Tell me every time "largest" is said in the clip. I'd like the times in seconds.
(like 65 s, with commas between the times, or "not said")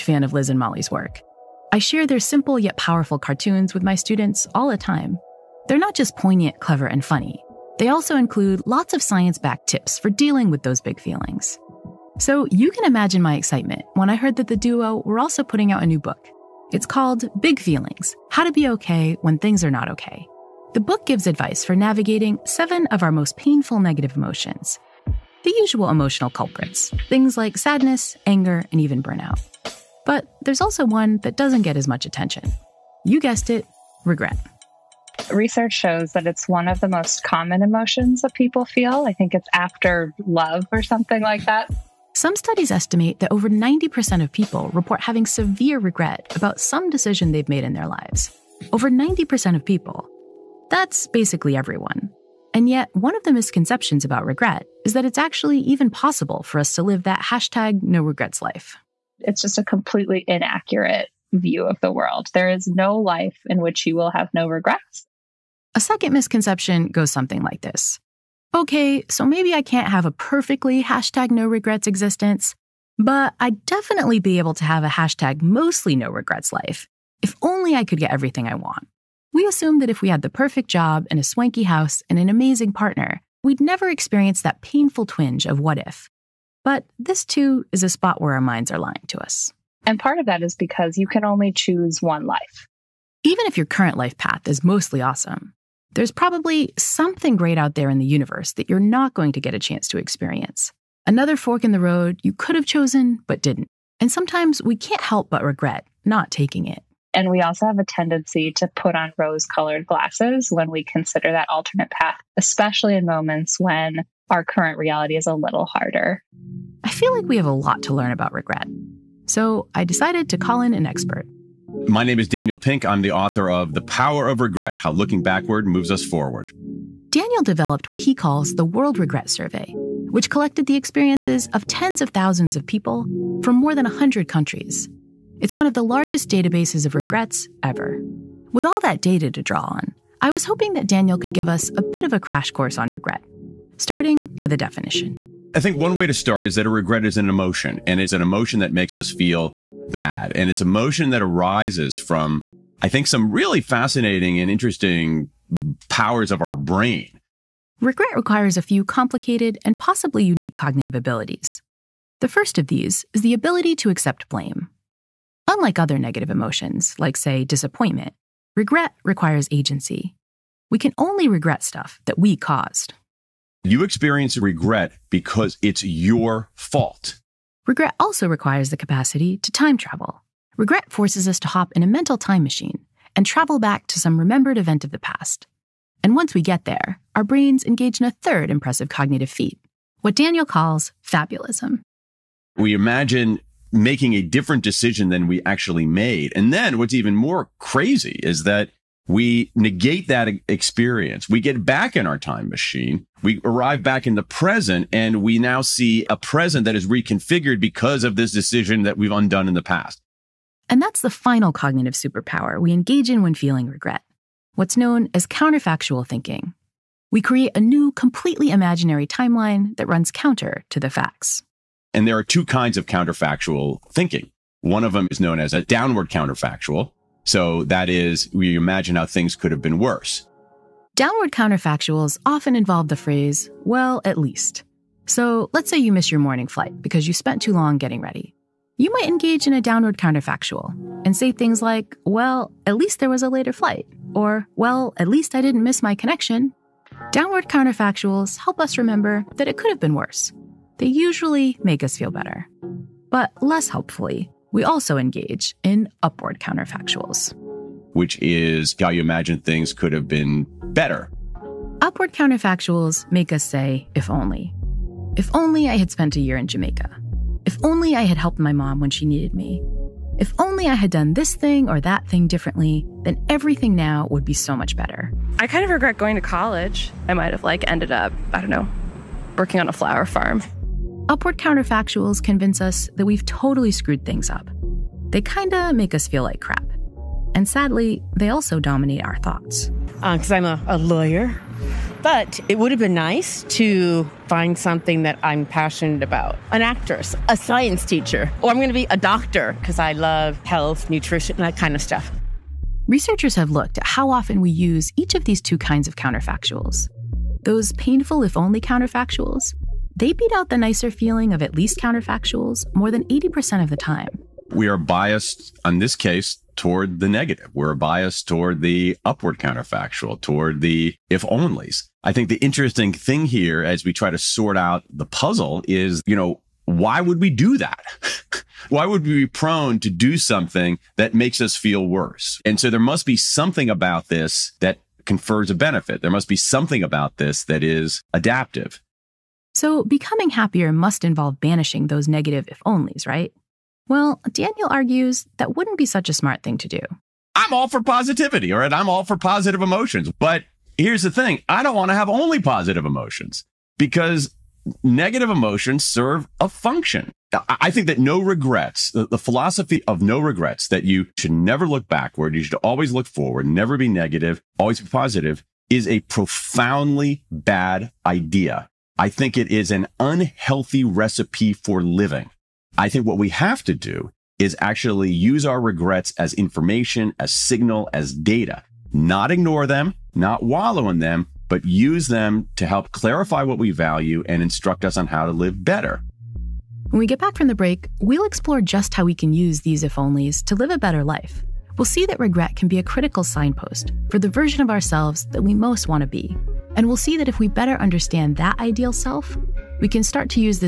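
135 s.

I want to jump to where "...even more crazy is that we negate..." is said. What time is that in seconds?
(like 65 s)
196 s.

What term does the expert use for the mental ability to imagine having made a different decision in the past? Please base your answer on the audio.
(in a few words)
fabulism.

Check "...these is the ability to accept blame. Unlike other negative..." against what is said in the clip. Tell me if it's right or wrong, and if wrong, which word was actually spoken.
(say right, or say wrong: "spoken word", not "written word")
right.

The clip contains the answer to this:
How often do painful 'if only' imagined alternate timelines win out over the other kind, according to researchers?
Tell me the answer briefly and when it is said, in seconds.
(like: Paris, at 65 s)
more than 80%, at 312 s.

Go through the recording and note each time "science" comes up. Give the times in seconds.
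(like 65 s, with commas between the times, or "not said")
9 s, 297 s.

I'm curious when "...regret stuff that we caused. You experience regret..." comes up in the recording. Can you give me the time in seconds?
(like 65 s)
171 s.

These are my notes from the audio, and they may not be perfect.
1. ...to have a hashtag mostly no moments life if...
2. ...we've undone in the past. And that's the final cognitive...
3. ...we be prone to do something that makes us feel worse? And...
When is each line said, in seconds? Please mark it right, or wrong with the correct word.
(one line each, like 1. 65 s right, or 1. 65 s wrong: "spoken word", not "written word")
1. 74 s wrong: "regrets", not "moments"
2. 208 s right
3. 329 s right.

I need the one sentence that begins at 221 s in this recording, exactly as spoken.
And there are two kinds of counterfactual thinking.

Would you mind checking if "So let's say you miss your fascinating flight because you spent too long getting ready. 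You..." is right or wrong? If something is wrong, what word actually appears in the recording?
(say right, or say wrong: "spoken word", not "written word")
wrong: "morning", not "fascinating".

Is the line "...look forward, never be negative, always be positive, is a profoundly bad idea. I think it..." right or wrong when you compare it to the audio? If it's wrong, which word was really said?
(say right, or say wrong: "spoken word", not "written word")
right.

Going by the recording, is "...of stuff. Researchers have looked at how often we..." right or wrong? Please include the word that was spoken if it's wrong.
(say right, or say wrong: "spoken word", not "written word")
right.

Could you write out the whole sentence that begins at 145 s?
I think one way to start is that a regret is an emotion, and it's an emotion that makes us feel bad.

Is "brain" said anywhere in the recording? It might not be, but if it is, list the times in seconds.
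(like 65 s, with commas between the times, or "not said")
156 s, 187 s.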